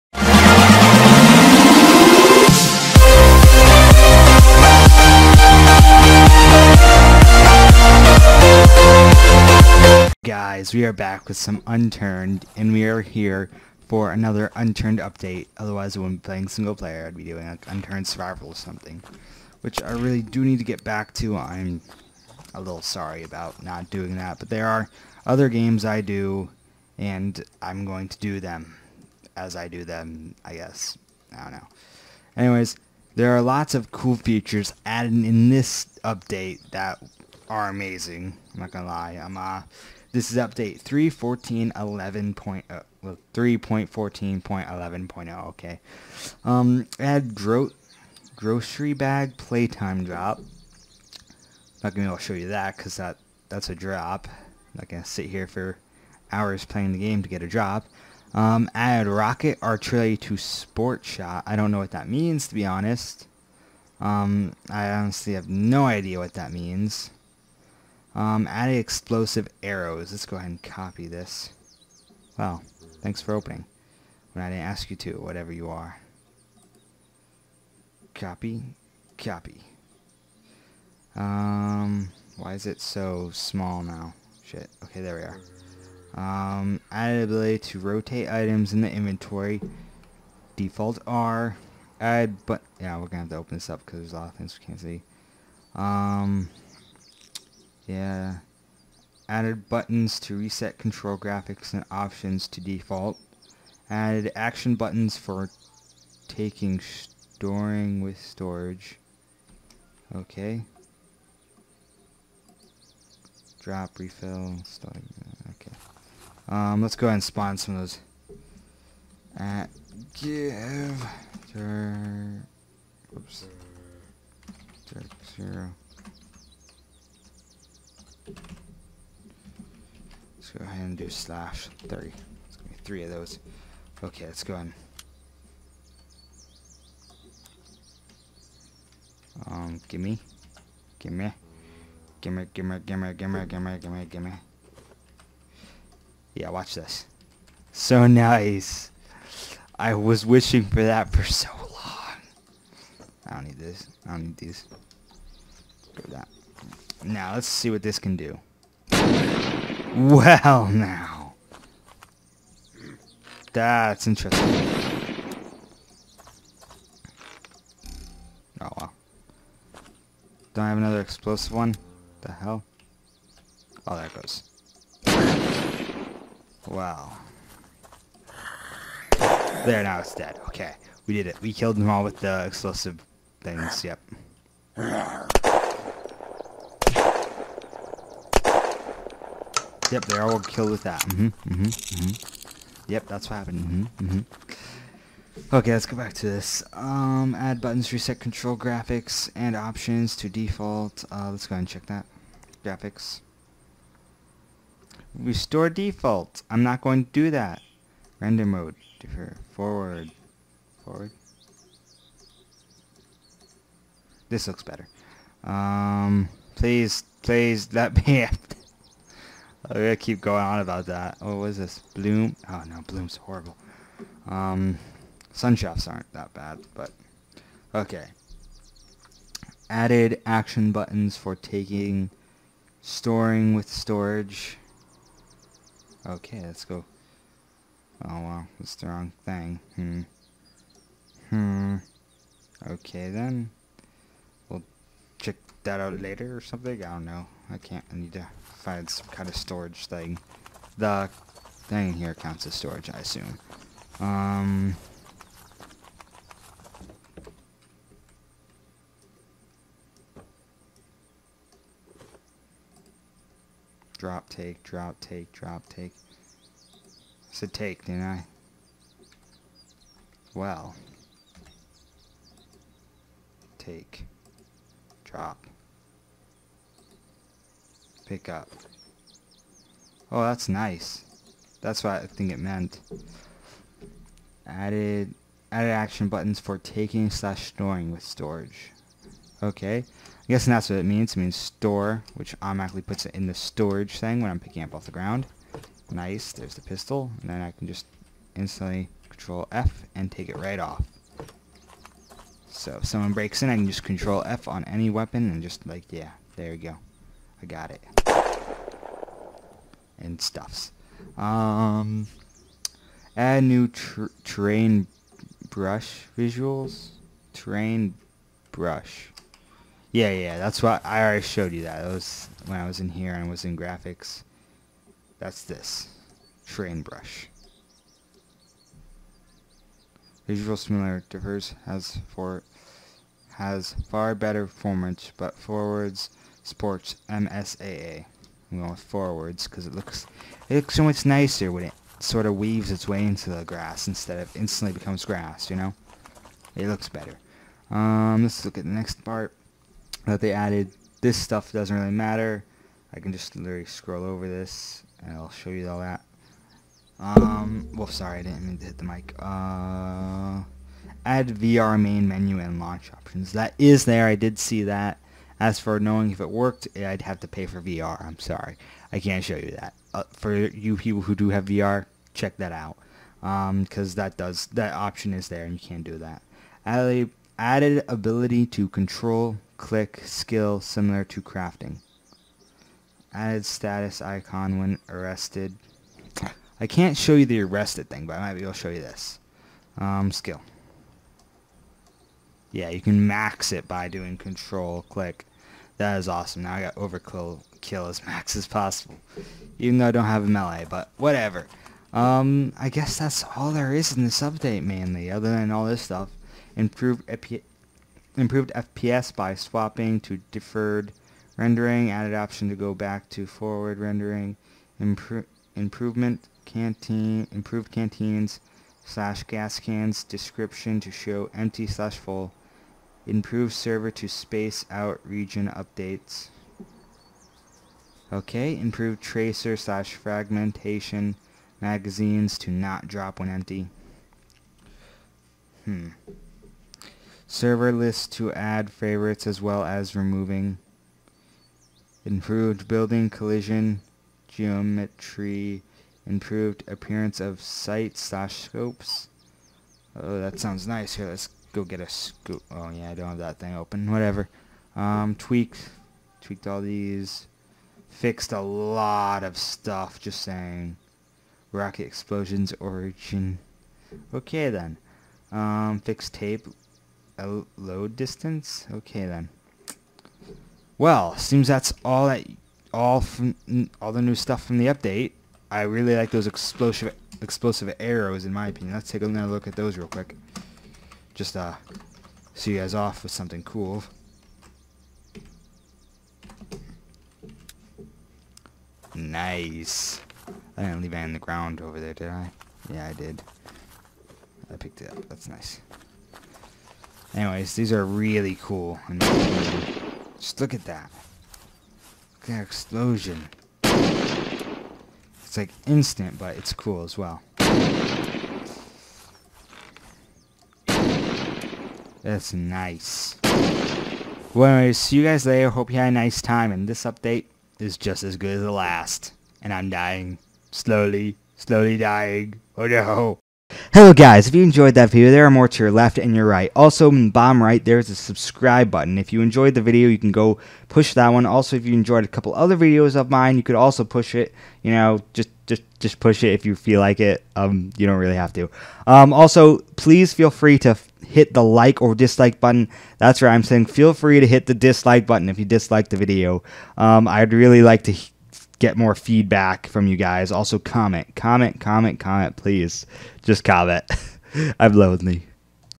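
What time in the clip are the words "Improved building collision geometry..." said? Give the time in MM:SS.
07:22.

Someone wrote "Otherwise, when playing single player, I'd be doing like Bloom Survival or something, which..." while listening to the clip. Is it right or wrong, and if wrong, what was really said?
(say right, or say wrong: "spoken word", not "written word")
wrong: "Unturned", not "Bloom".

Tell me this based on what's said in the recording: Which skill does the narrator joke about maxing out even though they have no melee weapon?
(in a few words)
Overkill.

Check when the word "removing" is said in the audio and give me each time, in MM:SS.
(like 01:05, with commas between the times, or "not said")
07:19.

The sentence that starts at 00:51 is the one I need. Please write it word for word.
Not gonna be able to show you that because that, that's a drop.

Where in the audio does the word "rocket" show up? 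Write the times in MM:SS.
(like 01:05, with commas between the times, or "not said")
00:59, 07:41.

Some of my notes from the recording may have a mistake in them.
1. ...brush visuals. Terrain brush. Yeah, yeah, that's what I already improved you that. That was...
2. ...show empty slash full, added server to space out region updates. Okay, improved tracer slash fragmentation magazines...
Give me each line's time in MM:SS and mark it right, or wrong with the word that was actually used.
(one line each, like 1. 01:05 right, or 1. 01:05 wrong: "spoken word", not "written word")
1. 05:15 wrong: "showed", not "improved"
2. 07:00 wrong: "improved", not "added".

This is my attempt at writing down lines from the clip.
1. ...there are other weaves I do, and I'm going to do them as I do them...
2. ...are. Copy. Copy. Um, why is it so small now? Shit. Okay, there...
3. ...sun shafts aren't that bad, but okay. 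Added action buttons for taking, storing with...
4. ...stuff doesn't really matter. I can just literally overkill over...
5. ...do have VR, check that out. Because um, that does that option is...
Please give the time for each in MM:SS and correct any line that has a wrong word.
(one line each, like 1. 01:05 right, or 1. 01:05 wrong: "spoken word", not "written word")
1. 00:24 wrong: "games", not "weaves"
2. 01:15 right
3. 03:45 right
4. 05:51 wrong: "scroll", not "overkill"
5. 06:11 right.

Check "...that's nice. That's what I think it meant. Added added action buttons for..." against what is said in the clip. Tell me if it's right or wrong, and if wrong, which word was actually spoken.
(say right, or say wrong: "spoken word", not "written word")
right.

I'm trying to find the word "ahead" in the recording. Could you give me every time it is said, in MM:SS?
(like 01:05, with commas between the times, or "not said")
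01:10, 01:57, 03:21.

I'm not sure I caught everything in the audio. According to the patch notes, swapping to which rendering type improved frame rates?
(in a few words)
Deferred rendering.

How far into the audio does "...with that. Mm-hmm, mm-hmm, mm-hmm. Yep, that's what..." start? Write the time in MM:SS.
03:10.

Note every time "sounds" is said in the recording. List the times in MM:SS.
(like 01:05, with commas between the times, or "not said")
07:30.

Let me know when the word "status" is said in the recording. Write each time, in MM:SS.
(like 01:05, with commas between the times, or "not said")
06:23.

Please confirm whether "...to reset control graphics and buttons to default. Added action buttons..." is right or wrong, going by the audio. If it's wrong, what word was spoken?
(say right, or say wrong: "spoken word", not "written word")
wrong: "options", not "buttons".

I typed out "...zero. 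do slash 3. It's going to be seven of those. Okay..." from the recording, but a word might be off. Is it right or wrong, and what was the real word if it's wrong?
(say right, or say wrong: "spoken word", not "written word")
wrong: "three", not "seven".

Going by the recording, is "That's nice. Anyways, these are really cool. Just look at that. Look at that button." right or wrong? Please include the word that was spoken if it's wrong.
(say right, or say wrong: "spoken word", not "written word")
wrong: "explosion", not "button".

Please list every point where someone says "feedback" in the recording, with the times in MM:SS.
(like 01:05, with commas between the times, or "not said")
09:08.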